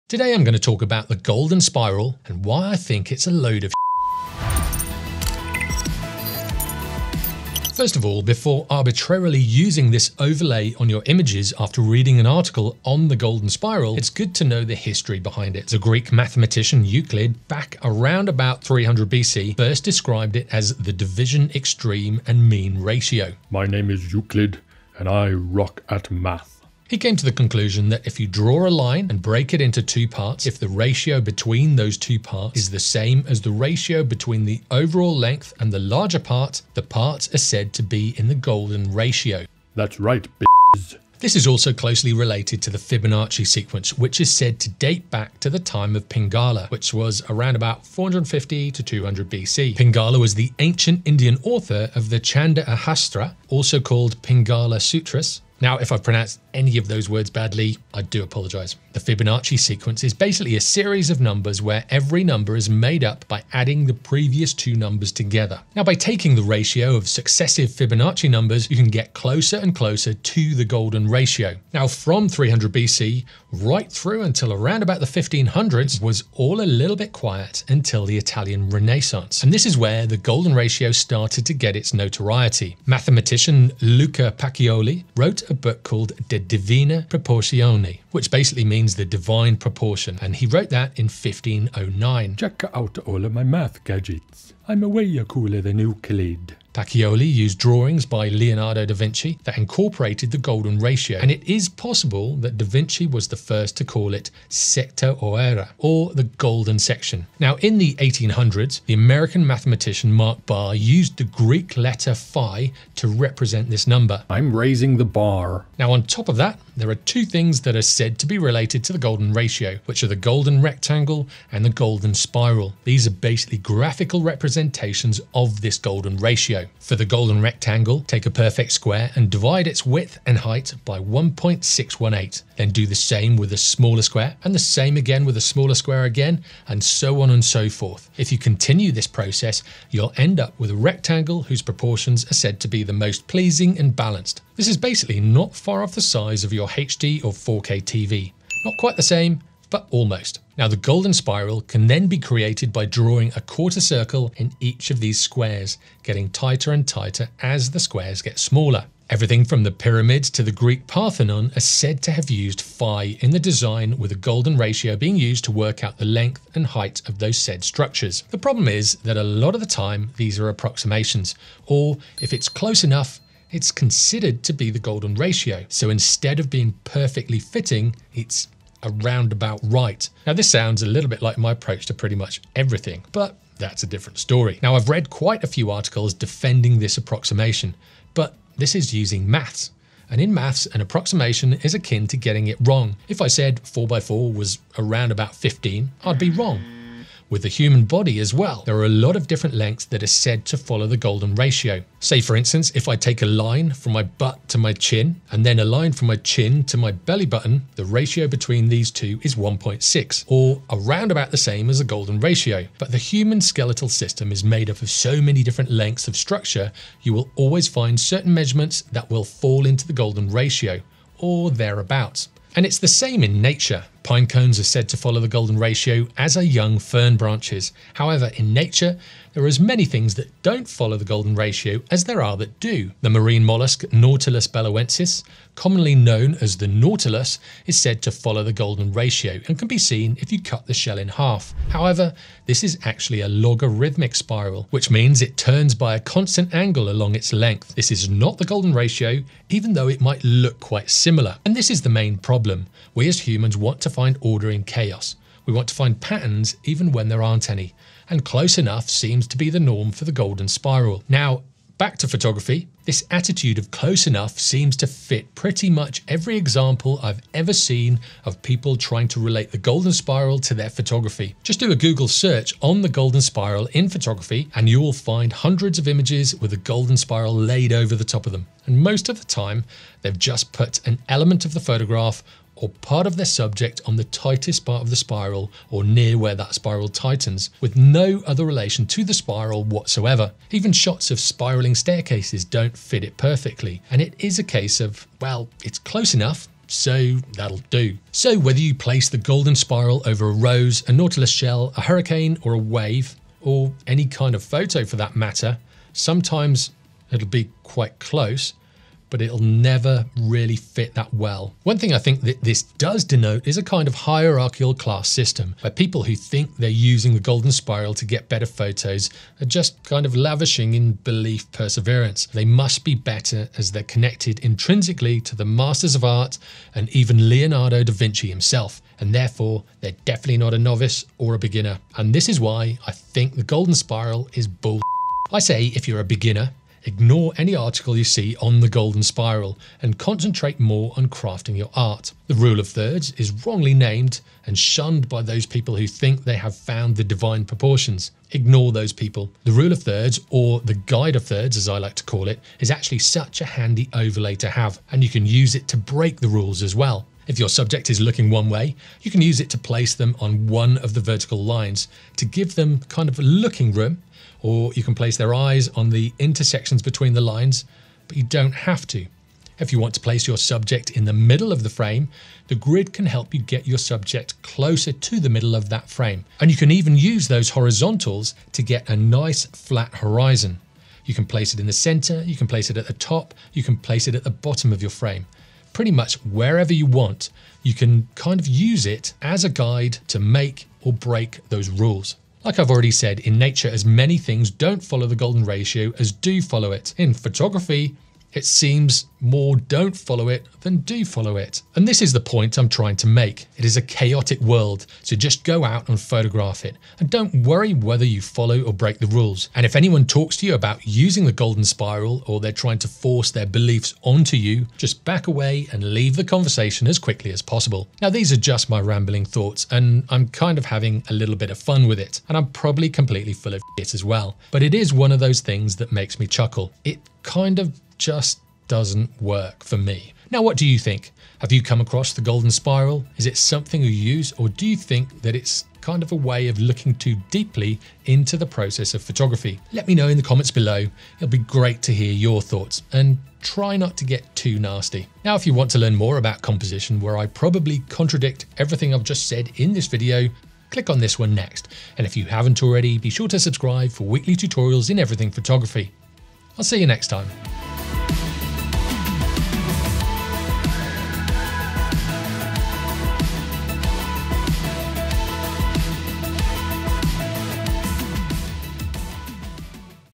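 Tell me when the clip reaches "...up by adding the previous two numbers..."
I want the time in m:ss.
1:03.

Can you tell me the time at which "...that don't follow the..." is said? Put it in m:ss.
3:50.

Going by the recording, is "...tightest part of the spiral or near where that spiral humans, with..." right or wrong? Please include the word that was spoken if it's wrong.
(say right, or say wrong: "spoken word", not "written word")
wrong: "tightens", not "humans".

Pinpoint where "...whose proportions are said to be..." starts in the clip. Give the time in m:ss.
2:21.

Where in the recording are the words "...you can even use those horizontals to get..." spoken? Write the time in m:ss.
6:16.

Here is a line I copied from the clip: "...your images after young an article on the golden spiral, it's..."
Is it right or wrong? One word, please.
wrong.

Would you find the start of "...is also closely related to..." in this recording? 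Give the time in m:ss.
0:41.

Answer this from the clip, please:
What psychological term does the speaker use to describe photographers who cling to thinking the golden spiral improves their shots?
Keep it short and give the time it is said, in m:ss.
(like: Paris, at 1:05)
Belief perseverance, at 5:20.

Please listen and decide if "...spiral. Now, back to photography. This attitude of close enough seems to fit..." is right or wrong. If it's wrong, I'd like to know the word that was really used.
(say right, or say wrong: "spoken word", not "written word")
right.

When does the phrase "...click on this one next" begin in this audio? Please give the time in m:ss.
7:30.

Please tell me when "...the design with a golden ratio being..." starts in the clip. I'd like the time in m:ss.
2:43.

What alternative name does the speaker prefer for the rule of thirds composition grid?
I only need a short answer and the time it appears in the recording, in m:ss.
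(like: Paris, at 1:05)
Guide of thirds, at 5:50.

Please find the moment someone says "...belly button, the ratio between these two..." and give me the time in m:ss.
3:26.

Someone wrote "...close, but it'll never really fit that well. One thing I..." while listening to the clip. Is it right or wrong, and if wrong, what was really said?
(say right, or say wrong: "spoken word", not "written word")
right.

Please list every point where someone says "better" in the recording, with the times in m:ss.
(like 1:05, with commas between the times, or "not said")
5:18, 5:22.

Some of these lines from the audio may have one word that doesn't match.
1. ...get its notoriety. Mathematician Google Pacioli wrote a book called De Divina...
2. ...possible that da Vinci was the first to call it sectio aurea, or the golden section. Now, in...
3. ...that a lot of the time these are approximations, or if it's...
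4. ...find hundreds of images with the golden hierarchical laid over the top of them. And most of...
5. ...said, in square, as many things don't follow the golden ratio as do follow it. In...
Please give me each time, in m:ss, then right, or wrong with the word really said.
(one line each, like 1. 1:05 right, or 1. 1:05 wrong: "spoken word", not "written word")
1. 1:21 wrong: "Luca", not "Google"
2. 1:41 right
3. 2:49 right
4. 4:34 wrong: "spiral", not "hierarchical"
5. 6:32 wrong: "nature", not "square".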